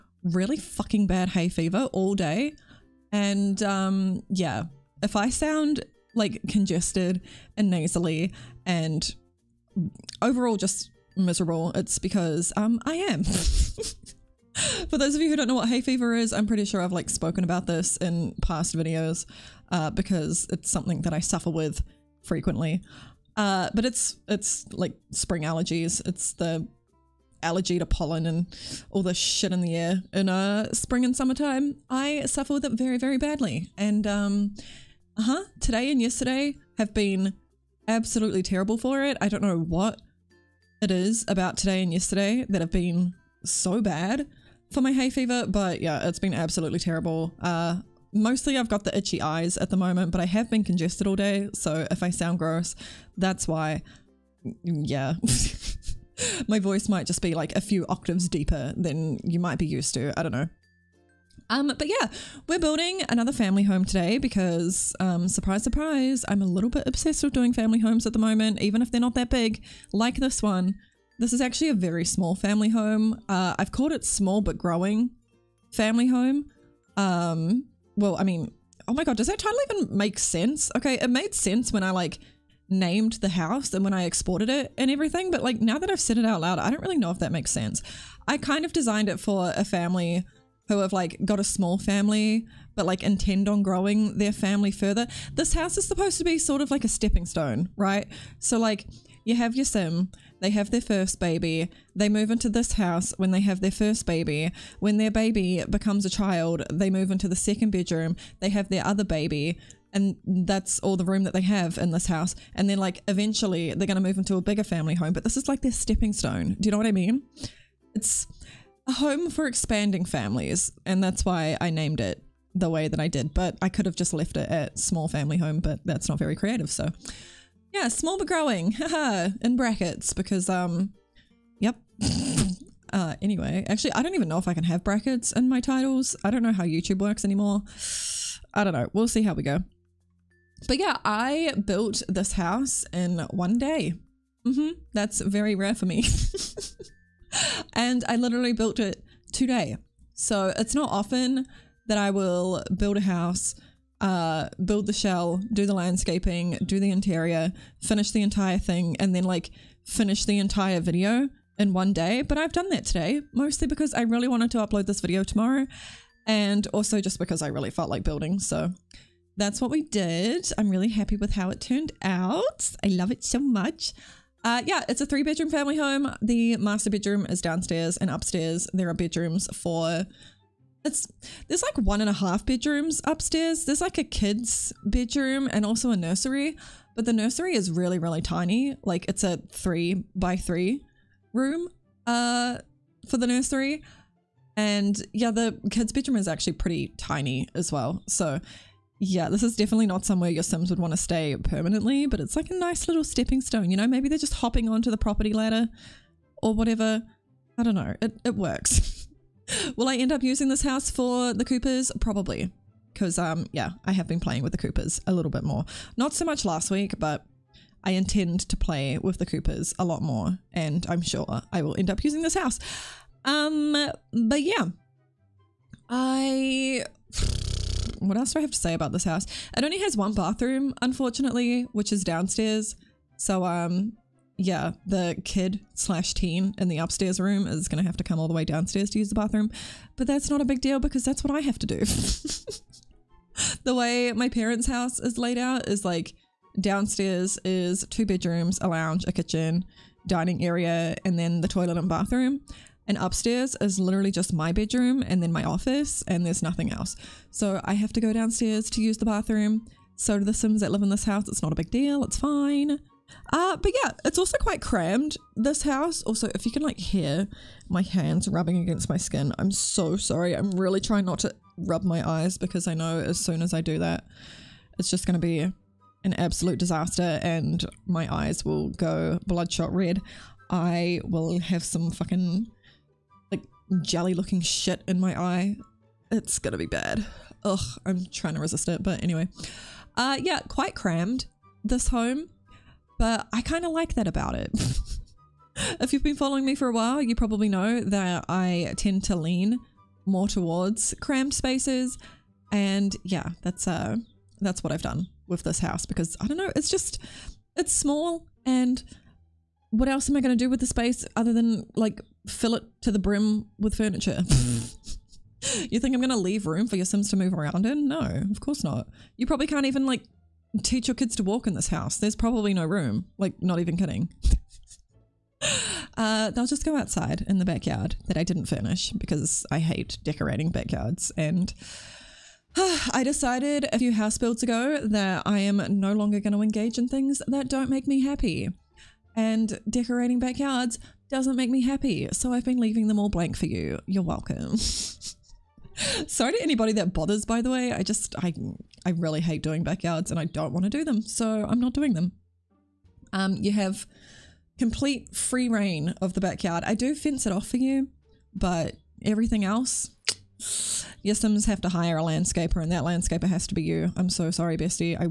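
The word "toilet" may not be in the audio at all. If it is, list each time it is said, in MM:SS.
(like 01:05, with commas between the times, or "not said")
04:11.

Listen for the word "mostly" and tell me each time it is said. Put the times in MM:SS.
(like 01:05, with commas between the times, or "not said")
00:48, 02:43.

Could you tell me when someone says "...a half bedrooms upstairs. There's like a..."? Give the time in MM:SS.
03:02.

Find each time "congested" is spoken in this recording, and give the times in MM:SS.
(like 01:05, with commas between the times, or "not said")
00:06, 00:50.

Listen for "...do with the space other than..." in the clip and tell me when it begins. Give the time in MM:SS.
05:10.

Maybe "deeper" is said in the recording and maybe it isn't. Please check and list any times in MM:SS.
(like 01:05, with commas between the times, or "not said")
00:58.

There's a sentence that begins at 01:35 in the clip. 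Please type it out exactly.
This house is supposed to be sort of like a stepping stone, right?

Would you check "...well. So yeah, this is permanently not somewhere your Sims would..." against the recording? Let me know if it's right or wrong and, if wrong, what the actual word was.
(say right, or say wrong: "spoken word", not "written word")
wrong: "definitely", not "permanently".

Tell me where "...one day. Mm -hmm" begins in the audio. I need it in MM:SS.
02:23.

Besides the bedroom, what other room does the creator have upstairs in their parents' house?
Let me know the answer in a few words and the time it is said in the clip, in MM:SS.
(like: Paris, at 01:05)
Office, at 04:15.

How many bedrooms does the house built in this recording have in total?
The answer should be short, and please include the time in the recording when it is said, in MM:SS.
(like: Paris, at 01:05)
3, at 02:55.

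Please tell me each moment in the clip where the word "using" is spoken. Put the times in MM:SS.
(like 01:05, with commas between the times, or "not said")
03:30, 03:42.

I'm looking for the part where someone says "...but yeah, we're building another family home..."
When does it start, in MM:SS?
01:01.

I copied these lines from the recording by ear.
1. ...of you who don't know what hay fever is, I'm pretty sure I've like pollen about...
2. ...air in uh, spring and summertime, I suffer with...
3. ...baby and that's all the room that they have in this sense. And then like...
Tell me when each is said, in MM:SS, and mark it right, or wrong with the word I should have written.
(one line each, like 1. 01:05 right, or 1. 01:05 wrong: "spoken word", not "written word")
1. 00:15 wrong: "spoken", not "pollen"
2. 00:29 right
3. 01:49 wrong: "house", not "sense".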